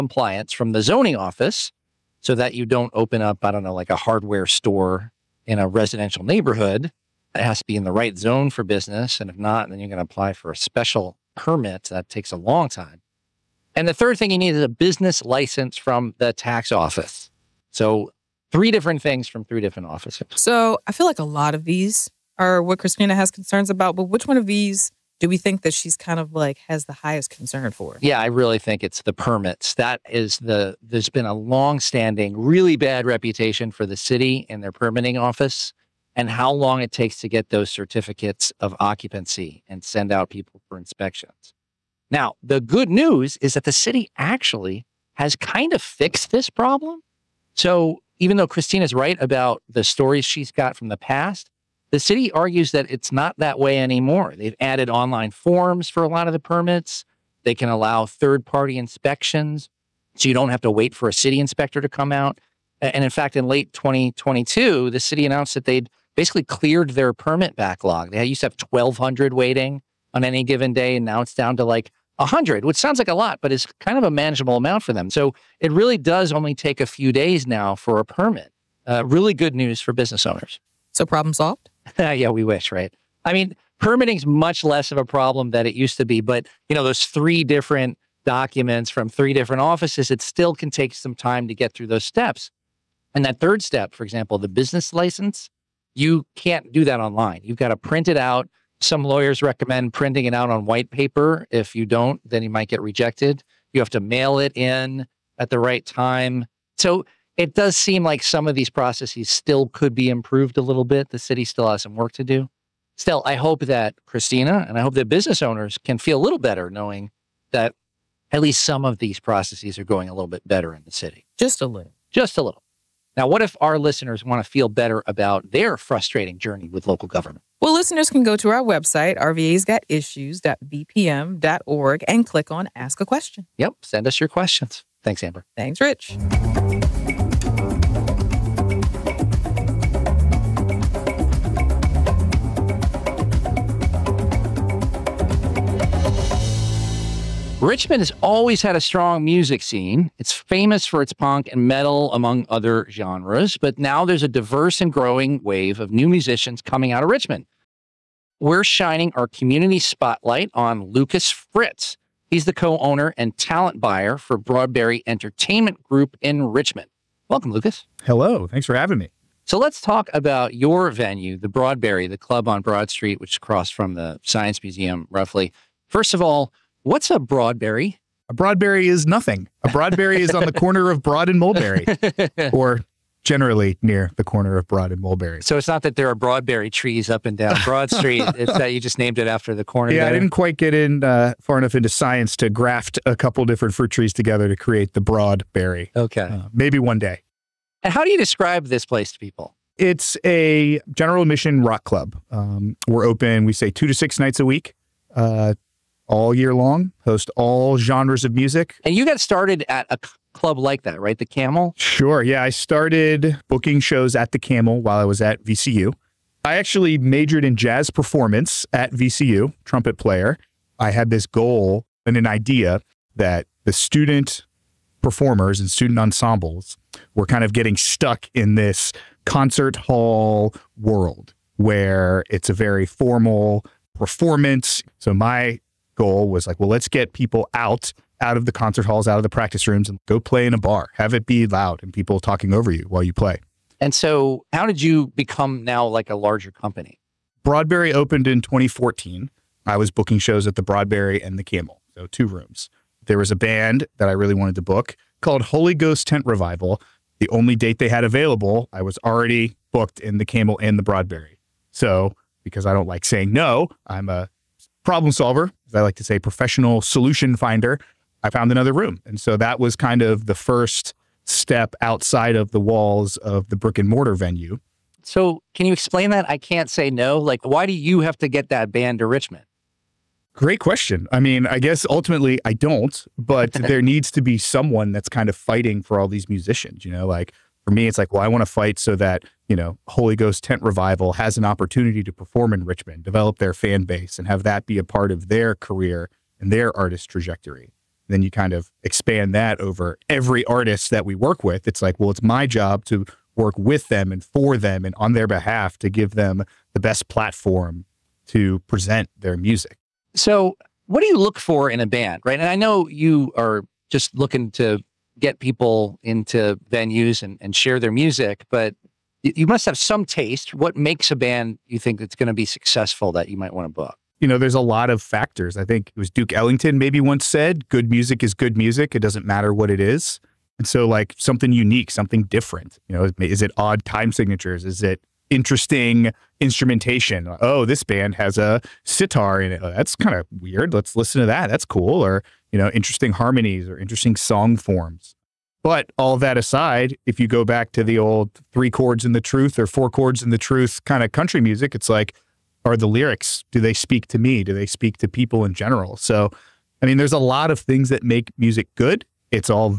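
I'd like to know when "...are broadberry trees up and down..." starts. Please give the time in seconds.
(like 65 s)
186 s.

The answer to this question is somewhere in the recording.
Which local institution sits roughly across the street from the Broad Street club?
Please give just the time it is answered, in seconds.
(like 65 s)
174 s.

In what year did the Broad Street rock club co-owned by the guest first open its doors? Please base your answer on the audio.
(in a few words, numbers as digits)
2014.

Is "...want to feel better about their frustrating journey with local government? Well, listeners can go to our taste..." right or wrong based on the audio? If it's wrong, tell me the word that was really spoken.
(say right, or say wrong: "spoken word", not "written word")
wrong: "website", not "taste".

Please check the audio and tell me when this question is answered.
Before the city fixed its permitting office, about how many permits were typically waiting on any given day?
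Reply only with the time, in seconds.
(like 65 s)
68 s.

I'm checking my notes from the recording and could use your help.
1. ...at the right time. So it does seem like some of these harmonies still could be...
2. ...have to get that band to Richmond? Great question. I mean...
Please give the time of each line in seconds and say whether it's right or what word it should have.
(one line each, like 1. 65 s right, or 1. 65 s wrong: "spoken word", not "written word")
1. 105 s wrong: "processes", not "harmonies"
2. 278 s right.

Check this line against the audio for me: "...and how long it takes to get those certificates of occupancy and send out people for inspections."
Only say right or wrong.
right.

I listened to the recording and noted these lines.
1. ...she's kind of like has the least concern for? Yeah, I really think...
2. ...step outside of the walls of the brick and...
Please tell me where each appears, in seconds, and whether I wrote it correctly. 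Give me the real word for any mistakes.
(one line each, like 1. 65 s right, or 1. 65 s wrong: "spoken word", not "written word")
1. 25 s wrong: "highest", not "least"
2. 271 s right.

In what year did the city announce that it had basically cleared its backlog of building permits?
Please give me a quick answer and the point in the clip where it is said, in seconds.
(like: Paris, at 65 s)
2022, at 63 s.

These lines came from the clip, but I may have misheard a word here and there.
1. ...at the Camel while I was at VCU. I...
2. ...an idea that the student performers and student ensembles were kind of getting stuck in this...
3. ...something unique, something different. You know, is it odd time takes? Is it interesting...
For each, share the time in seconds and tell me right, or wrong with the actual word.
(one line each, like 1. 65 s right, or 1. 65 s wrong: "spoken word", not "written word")
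1. 214 s right
2. 222 s right
3. 331 s wrong: "signatures", not "takes".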